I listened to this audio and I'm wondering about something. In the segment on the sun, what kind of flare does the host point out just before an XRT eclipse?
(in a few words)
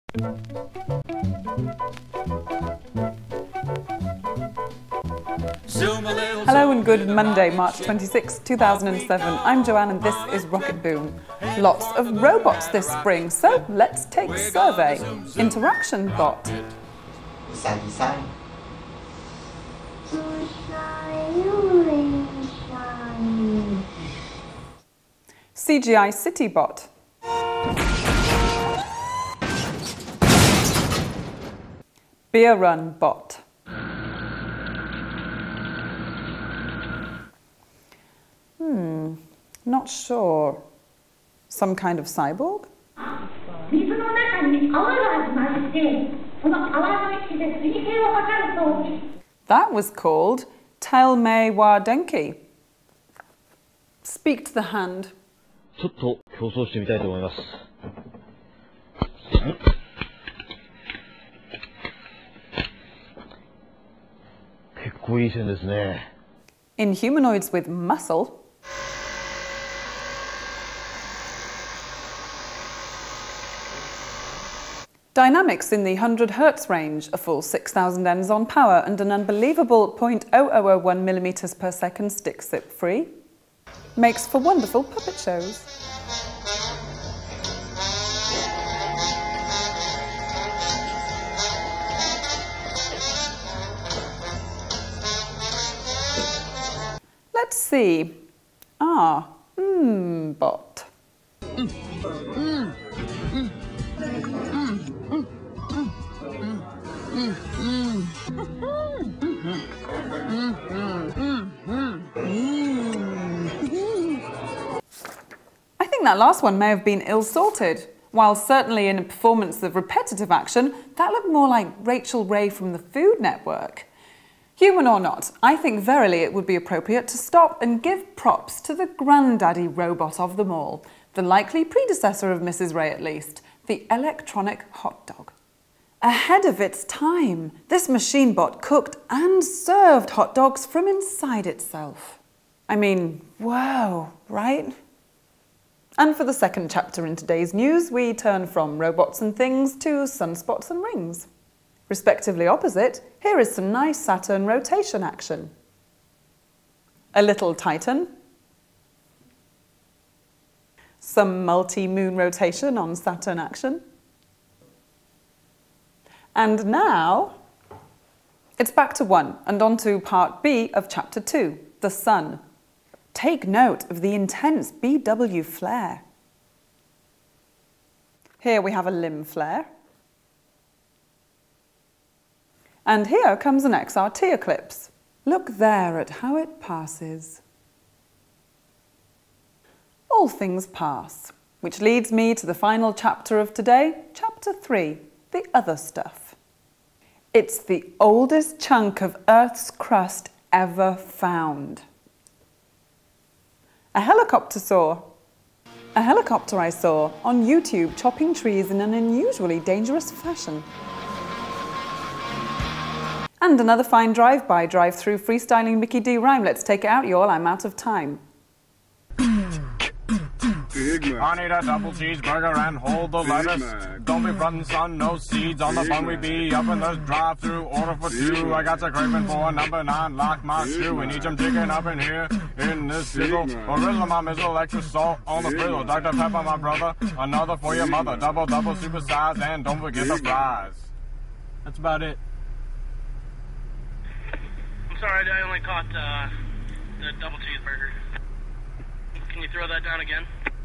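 A limb flare.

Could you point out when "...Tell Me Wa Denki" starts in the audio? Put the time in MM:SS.
00:50.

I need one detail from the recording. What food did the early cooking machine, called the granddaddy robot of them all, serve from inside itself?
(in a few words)
Hot dogs.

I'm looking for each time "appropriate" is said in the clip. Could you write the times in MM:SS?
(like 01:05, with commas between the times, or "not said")
02:06.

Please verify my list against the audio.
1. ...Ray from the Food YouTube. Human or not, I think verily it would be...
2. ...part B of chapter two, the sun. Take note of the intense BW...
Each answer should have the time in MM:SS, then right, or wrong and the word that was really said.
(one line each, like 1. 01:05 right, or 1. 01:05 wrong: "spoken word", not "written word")
1. 02:02 wrong: "Network", not "YouTube"
2. 02:49 right.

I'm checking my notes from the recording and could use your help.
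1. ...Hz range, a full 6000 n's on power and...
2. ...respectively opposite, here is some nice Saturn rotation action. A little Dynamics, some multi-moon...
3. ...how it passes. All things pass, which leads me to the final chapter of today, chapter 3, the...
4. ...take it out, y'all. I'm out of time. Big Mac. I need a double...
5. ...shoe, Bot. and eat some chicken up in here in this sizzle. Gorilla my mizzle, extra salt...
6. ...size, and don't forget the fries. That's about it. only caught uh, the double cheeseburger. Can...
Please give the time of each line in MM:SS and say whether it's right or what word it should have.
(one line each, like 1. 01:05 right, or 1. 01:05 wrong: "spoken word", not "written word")
1. 01:16 right
2. 02:31 wrong: "Titan", not "Dynamics"
3. 03:06 right
4. 03:36 right
5. 03:50 wrong: "Mac", not "Bot"
6. 03:59 right.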